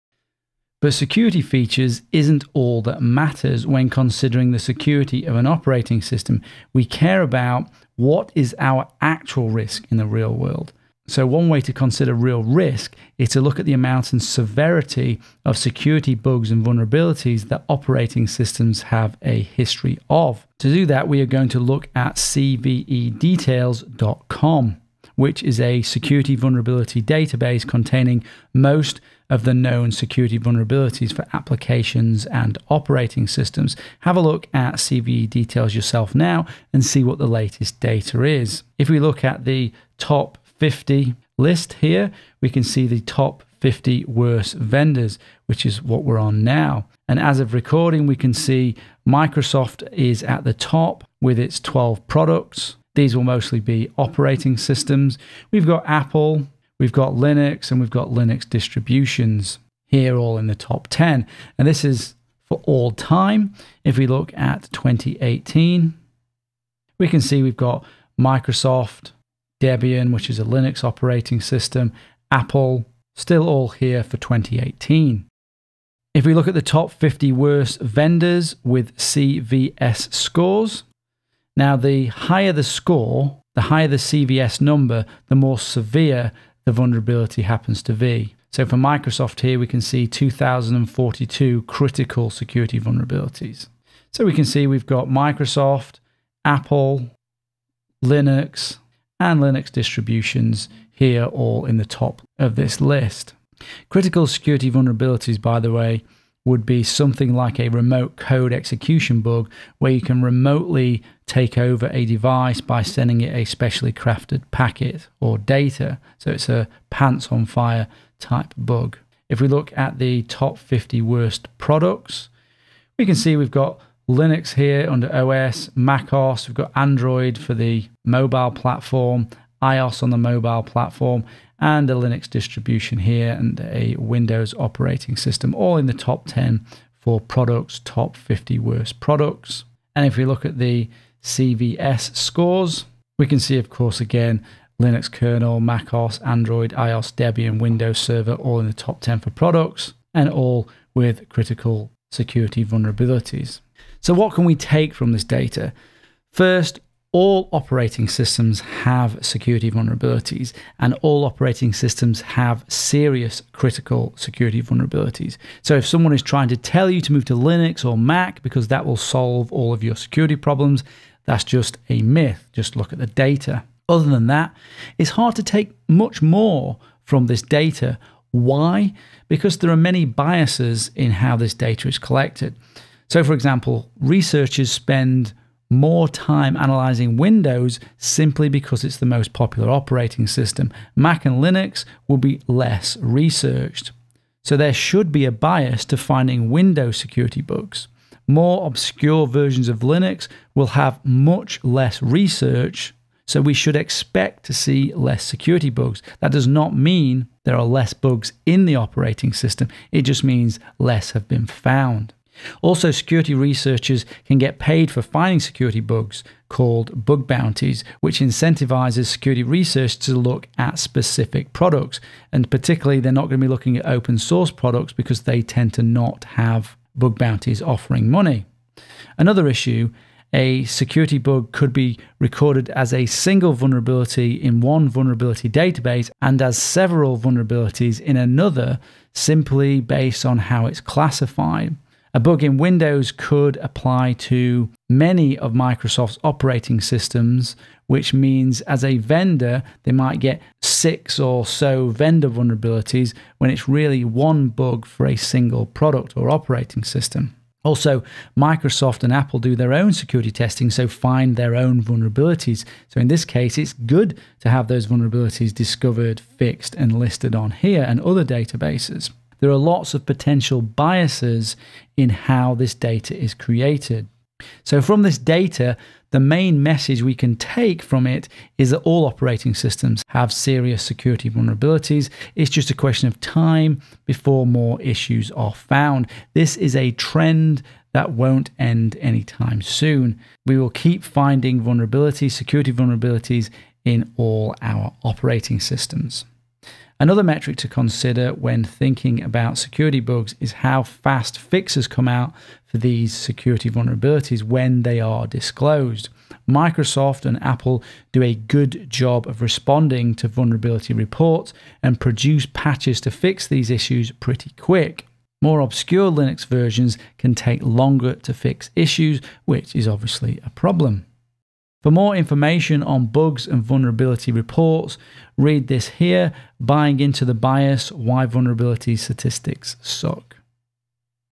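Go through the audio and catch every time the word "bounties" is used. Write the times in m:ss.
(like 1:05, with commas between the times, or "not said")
3:37, 3:47.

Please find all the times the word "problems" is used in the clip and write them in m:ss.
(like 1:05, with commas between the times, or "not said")
2:50, 5:20.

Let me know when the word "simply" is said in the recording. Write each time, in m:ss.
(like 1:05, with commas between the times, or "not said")
3:07, 3:59.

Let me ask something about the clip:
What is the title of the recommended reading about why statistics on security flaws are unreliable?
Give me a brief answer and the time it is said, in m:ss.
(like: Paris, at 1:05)
Buying into the Bias, at 5:26.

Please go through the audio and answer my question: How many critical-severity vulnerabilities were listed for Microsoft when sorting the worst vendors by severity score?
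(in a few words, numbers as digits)
2042.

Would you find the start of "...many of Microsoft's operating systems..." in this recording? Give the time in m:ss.
4:04.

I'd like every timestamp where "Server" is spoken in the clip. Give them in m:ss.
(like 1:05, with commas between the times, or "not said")
2:27.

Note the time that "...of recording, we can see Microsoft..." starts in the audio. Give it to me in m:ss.
0:47.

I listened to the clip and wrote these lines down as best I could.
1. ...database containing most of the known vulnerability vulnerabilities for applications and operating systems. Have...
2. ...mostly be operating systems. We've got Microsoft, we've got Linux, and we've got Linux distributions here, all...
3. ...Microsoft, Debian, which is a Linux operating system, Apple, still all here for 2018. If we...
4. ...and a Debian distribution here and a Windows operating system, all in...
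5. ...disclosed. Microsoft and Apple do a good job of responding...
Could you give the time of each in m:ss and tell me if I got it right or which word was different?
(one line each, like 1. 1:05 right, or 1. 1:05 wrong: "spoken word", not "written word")
1. 0:26 wrong: "security", not "vulnerability"
2. 0:53 wrong: "Apple", not "Microsoft"
3. 1:08 right
4. 2:11 wrong: "Linux", not "Debian"
5. 5:05 right.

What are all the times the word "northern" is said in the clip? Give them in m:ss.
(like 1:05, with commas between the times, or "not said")
not said.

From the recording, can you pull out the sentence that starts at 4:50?
We will keep finding vulnerabilities, security vulnerabilities in all our operating systems.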